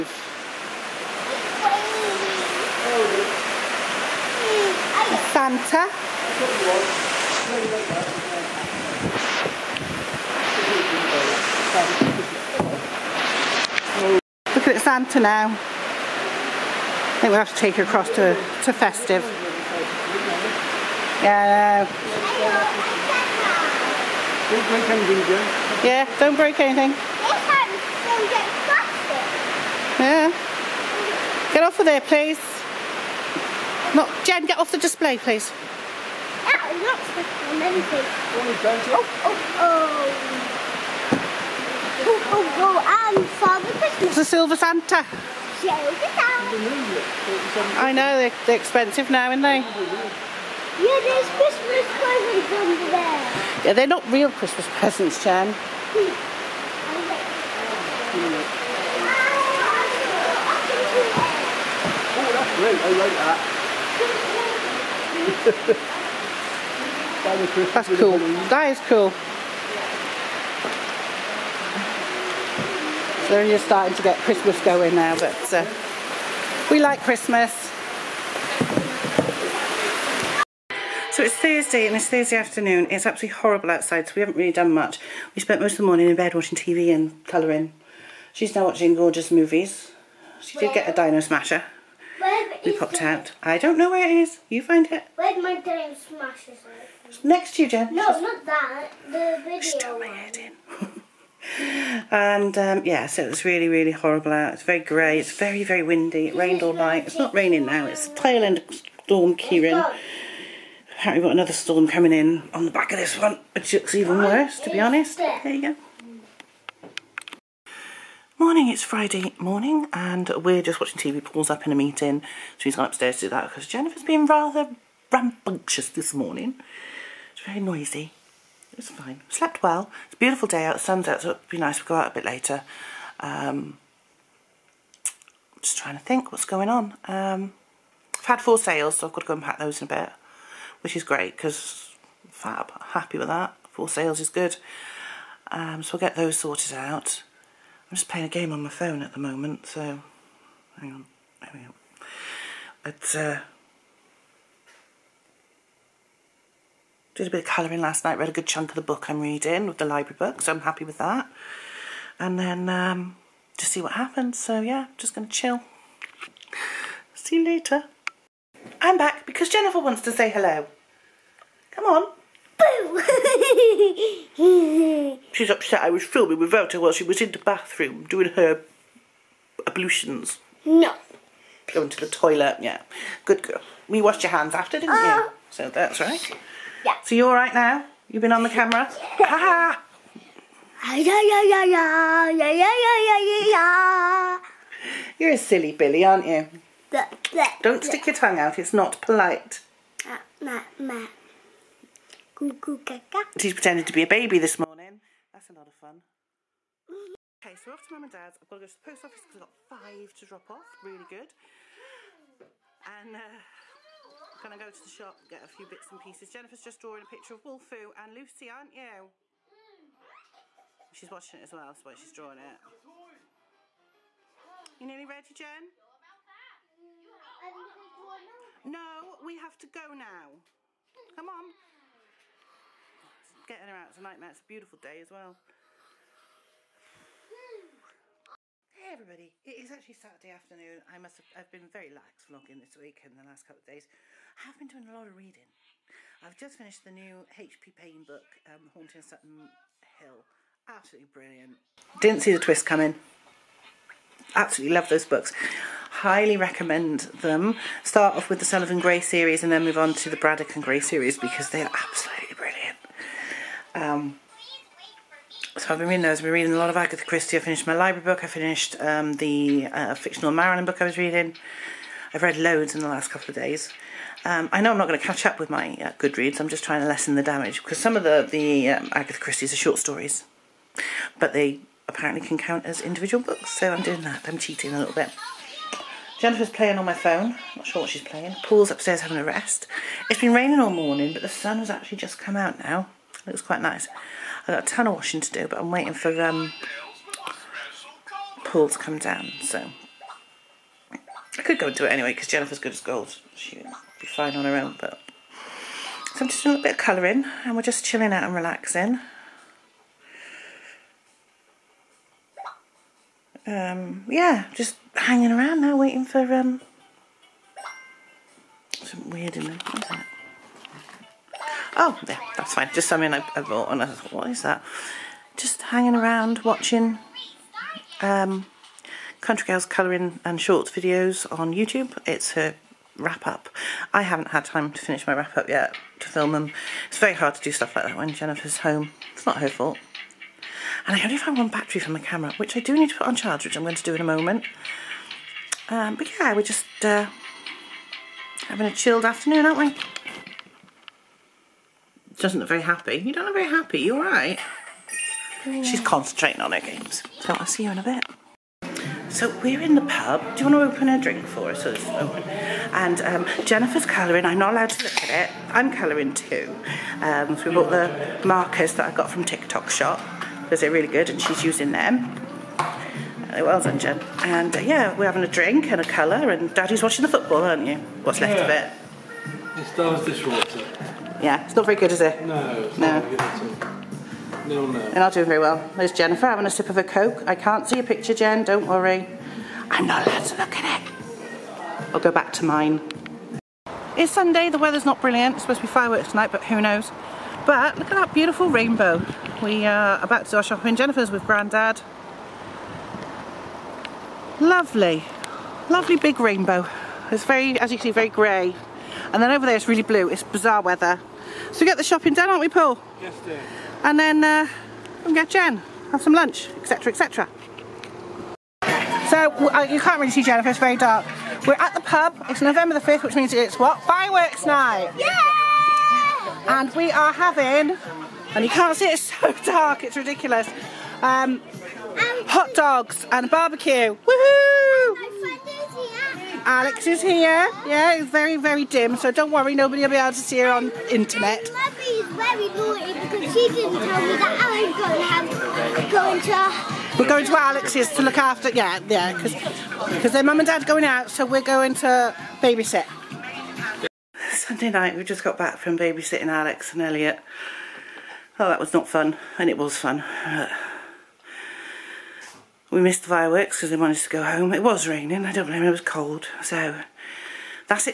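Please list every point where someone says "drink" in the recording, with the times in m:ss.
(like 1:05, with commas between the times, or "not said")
6:01, 6:15.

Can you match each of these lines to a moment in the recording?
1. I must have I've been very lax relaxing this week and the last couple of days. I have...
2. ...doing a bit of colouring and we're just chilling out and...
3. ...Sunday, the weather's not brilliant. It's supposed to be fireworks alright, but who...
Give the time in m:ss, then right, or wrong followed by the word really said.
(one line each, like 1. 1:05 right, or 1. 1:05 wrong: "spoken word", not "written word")
1. 4:00 wrong: "vlogging", not "relaxing"
2. 5:06 right
3. 6:34 wrong: "tonight", not "alright".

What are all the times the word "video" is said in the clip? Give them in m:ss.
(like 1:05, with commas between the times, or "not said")
1:39, 5:30.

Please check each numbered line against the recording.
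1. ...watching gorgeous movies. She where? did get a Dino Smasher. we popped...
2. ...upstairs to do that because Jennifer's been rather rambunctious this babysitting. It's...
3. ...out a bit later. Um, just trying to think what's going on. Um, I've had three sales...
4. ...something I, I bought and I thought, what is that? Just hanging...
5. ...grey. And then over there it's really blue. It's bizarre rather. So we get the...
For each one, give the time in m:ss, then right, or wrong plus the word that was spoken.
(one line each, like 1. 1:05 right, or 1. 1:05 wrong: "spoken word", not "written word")
1. 1:28 right
2. 2:02 wrong: "morning", not "babysitting"
3. 2:11 wrong: "four", not "three"
4. 5:22 right
5. 6:48 wrong: "weather", not "rather".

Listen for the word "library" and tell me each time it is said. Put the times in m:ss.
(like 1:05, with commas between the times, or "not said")
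2:39, 4:27.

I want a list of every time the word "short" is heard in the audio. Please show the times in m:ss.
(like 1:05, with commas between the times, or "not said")
4:39, 5:30.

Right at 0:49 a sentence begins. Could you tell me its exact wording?
Yeah, there's Christmas presents under there.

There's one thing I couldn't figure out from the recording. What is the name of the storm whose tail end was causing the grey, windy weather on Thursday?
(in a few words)
Storm Ciarán.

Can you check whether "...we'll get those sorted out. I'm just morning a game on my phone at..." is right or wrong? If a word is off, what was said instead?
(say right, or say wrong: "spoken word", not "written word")
wrong: "playing", not "morning".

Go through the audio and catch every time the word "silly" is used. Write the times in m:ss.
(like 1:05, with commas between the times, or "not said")
3:15.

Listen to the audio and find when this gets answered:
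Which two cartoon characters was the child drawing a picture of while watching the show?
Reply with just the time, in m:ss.
3:37.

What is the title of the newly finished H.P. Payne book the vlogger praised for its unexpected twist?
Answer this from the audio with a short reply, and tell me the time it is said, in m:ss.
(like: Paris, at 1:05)
Haunting Sutton Hill, at 4:08.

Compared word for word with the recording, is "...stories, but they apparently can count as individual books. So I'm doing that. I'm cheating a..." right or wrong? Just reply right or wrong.
right.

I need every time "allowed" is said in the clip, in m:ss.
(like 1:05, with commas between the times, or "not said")
6:04, 6:30.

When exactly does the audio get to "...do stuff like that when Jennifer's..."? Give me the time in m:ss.
5:37.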